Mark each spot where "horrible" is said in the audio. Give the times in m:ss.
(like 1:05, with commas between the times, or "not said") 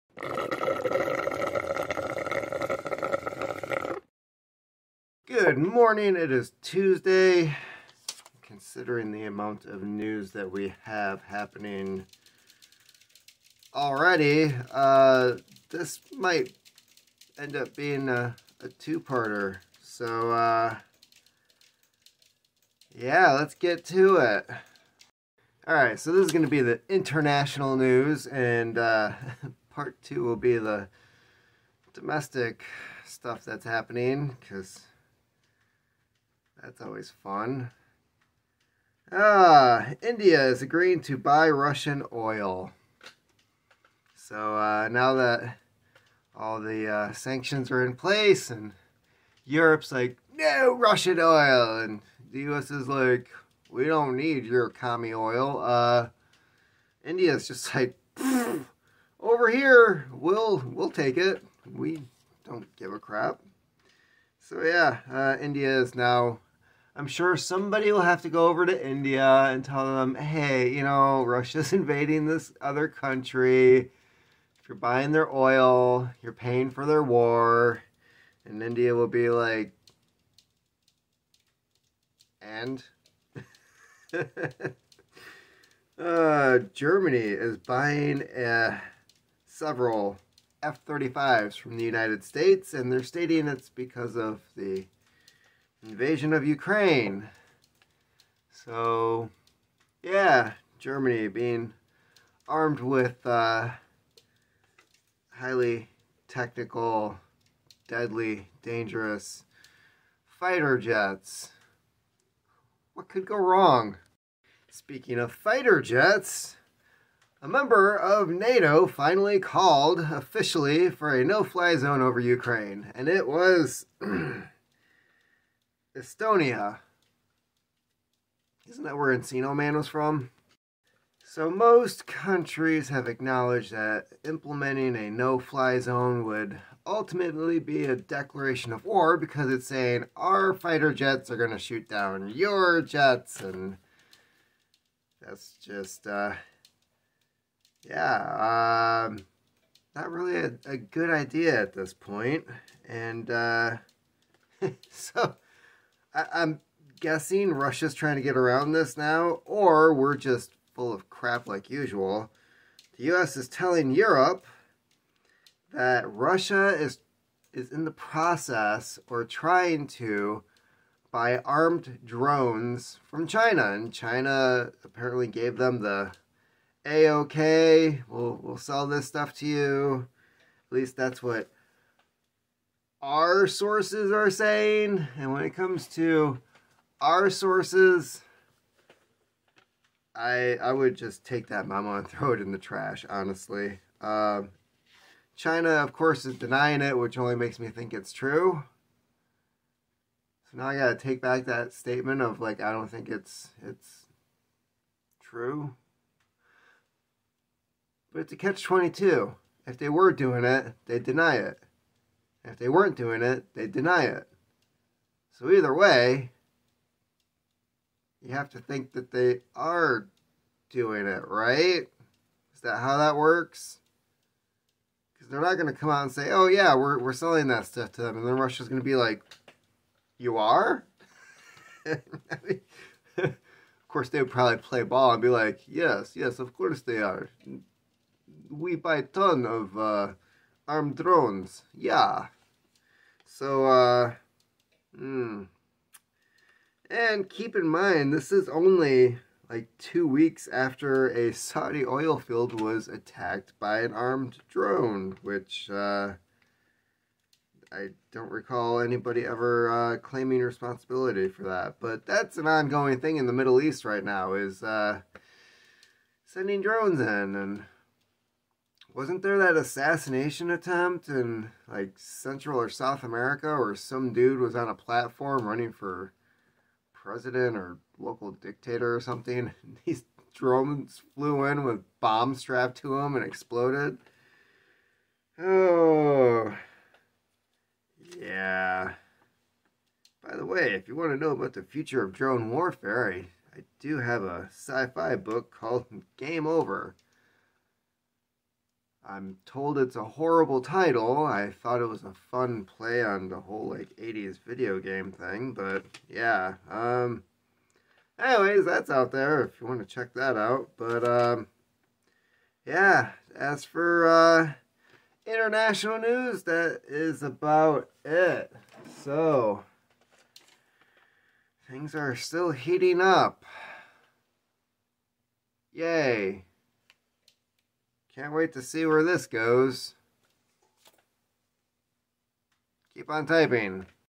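5:00.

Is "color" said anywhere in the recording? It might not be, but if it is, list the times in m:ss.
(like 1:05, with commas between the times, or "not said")
not said.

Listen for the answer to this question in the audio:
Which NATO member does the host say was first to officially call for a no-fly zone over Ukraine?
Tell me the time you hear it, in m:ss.
2:05.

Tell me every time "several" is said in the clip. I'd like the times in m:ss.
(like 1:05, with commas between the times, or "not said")
1:29.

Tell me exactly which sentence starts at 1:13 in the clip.
If you're buying their oil, you're paying for their war, and India will be like, and.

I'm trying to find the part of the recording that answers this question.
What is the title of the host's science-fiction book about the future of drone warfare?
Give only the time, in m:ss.
4:56.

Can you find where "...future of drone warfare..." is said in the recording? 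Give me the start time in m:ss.
4:51.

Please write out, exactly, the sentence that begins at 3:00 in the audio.
At least that's what our sources are saying.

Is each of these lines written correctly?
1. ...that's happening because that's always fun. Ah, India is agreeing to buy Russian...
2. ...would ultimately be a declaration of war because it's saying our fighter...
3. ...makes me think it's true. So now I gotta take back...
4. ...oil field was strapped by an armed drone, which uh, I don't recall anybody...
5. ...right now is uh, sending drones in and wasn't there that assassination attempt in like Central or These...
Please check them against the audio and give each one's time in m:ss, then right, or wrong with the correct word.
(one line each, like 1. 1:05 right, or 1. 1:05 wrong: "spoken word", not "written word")
1. 0:33 right
2. 2:16 right
3. 3:17 right
4. 4:11 wrong: "attacked", not "strapped"
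5. 4:23 wrong: "South", not "These".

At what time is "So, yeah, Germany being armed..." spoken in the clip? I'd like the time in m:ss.
1:38.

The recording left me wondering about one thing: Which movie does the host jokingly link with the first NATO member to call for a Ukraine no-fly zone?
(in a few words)
Encino Man.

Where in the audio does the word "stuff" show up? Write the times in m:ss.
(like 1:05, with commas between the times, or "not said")
0:33, 2:59, 3:47.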